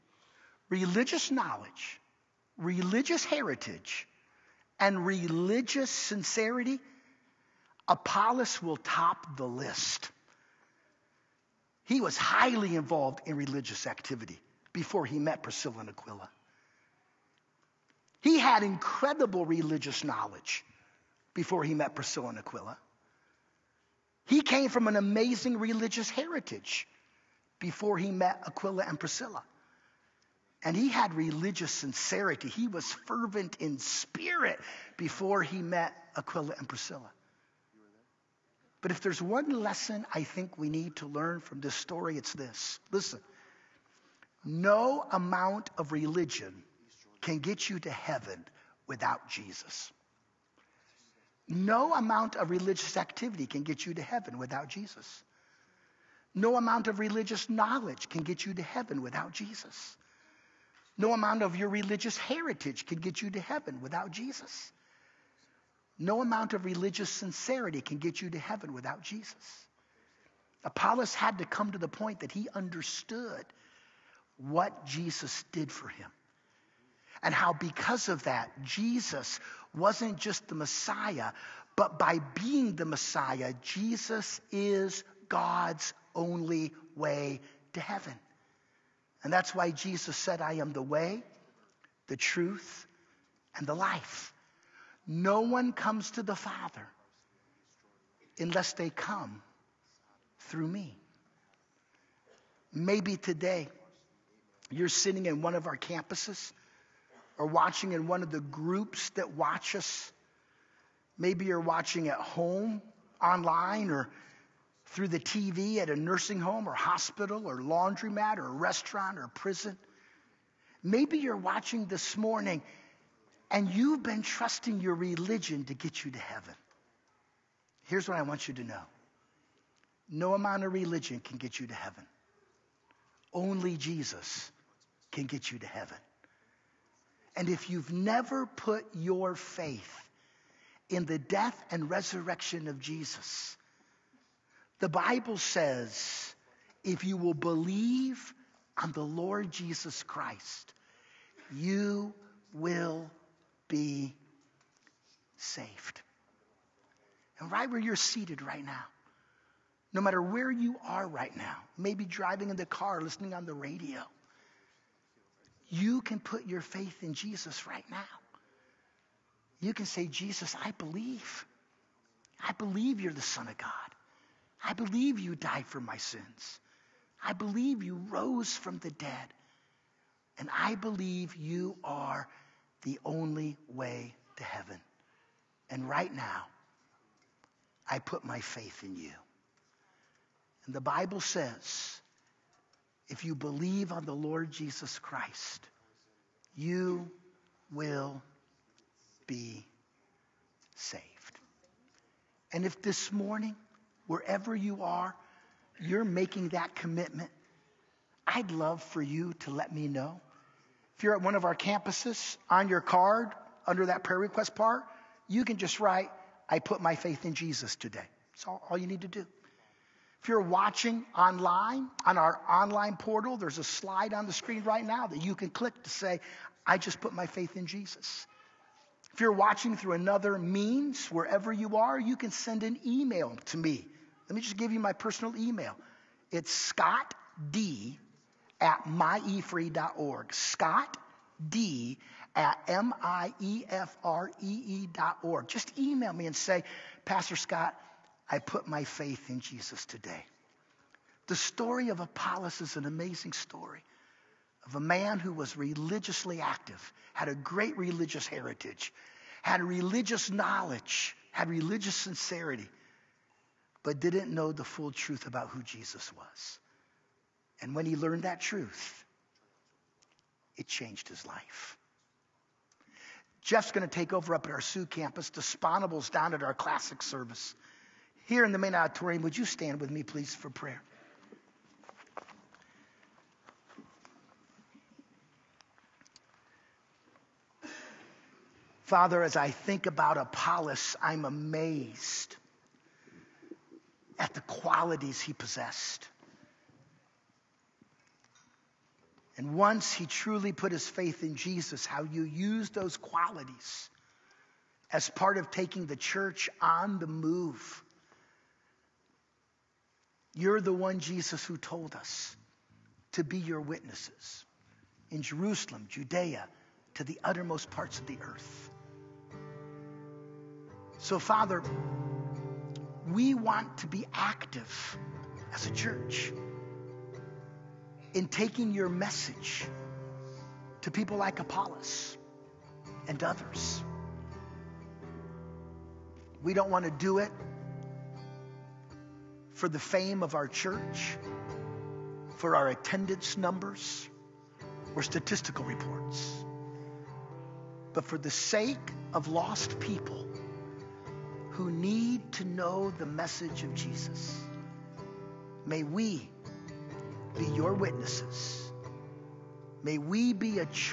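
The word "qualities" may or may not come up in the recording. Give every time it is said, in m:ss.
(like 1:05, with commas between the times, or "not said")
4:54, 5:02.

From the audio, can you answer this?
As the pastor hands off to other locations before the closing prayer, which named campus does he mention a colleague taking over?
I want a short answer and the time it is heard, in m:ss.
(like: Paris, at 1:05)
Sioux, at 4:34.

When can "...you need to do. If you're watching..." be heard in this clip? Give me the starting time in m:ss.
3:38.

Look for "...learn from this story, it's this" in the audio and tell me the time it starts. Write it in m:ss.
0:41.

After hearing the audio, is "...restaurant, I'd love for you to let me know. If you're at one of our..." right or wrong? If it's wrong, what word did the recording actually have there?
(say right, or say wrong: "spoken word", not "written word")
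wrong: "commitment", not "restaurant".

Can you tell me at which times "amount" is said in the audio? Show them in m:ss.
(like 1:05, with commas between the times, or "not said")
0:45, 0:51, 0:56, 1:01, 1:06, 2:10.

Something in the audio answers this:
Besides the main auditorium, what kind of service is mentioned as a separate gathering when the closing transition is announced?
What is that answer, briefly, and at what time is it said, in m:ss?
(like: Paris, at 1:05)
classic service, at 4:36.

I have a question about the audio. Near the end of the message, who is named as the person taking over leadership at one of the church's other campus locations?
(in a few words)
Jeff.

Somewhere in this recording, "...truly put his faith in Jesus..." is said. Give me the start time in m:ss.
5:00.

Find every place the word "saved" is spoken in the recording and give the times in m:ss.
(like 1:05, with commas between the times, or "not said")
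2:35, 3:20.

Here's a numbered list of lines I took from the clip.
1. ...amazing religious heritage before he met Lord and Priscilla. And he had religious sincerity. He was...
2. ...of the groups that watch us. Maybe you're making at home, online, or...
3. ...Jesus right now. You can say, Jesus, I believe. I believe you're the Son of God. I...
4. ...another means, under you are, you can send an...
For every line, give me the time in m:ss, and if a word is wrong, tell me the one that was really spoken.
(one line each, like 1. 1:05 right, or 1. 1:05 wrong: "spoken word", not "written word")
1. 0:24 wrong: "Aquila", not "Lord"
2. 1:48 wrong: "watching", not "making"
3. 2:47 right
4. 3:49 wrong: "wherever", not "under".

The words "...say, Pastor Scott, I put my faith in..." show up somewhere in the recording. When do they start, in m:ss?
4:06.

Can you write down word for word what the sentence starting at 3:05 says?
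And right now, I put my faith in you.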